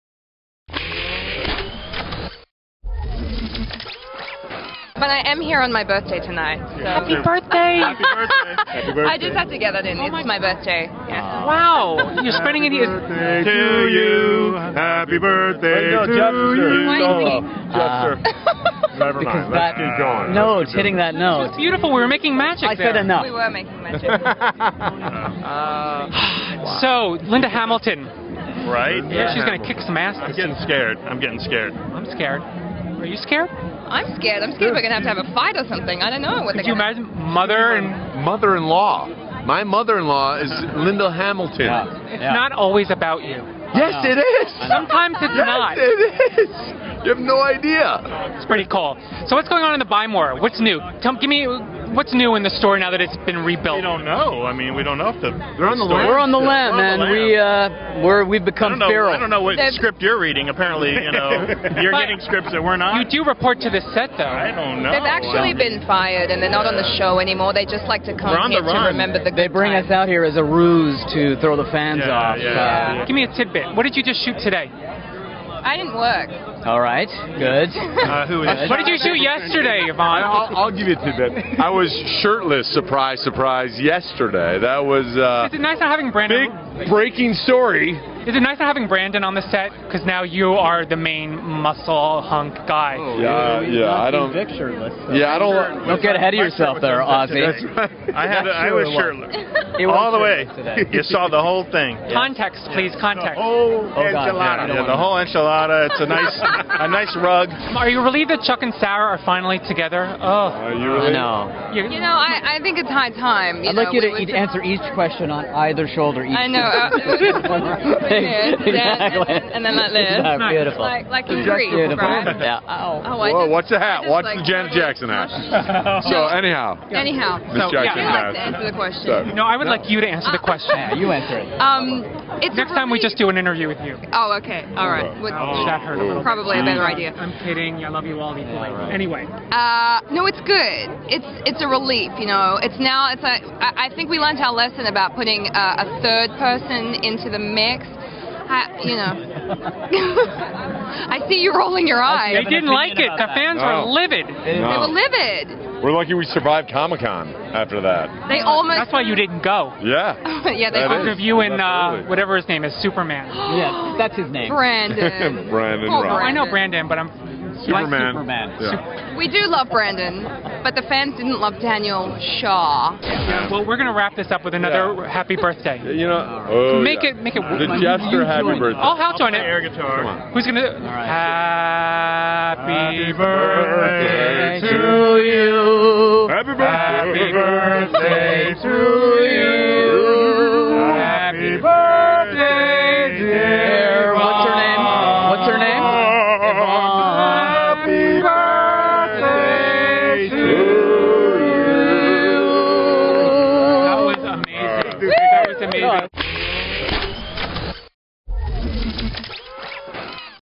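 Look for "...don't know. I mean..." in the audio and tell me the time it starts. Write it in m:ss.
0:53.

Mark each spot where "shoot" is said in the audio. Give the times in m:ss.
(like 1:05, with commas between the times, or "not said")
1:14, 1:18.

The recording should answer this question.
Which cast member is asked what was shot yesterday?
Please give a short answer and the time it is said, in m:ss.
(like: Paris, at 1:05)
Yvonne, at 1:19.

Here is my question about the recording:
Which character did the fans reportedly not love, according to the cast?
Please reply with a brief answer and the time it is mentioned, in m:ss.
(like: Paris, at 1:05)
Daniel Shaw, at 2:51.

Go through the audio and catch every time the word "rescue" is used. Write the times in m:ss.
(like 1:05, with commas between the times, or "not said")
not said.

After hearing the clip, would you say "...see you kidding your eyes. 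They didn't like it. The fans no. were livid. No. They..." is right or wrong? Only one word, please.
wrong.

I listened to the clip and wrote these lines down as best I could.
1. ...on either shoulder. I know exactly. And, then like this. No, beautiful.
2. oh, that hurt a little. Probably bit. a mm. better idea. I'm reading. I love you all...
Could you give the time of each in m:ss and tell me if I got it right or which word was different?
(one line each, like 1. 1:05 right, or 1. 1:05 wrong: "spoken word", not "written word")
1. 1:55 right
2. 2:15 wrong: "kidding", not "reading".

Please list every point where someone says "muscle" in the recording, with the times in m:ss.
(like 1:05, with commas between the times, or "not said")
1:31.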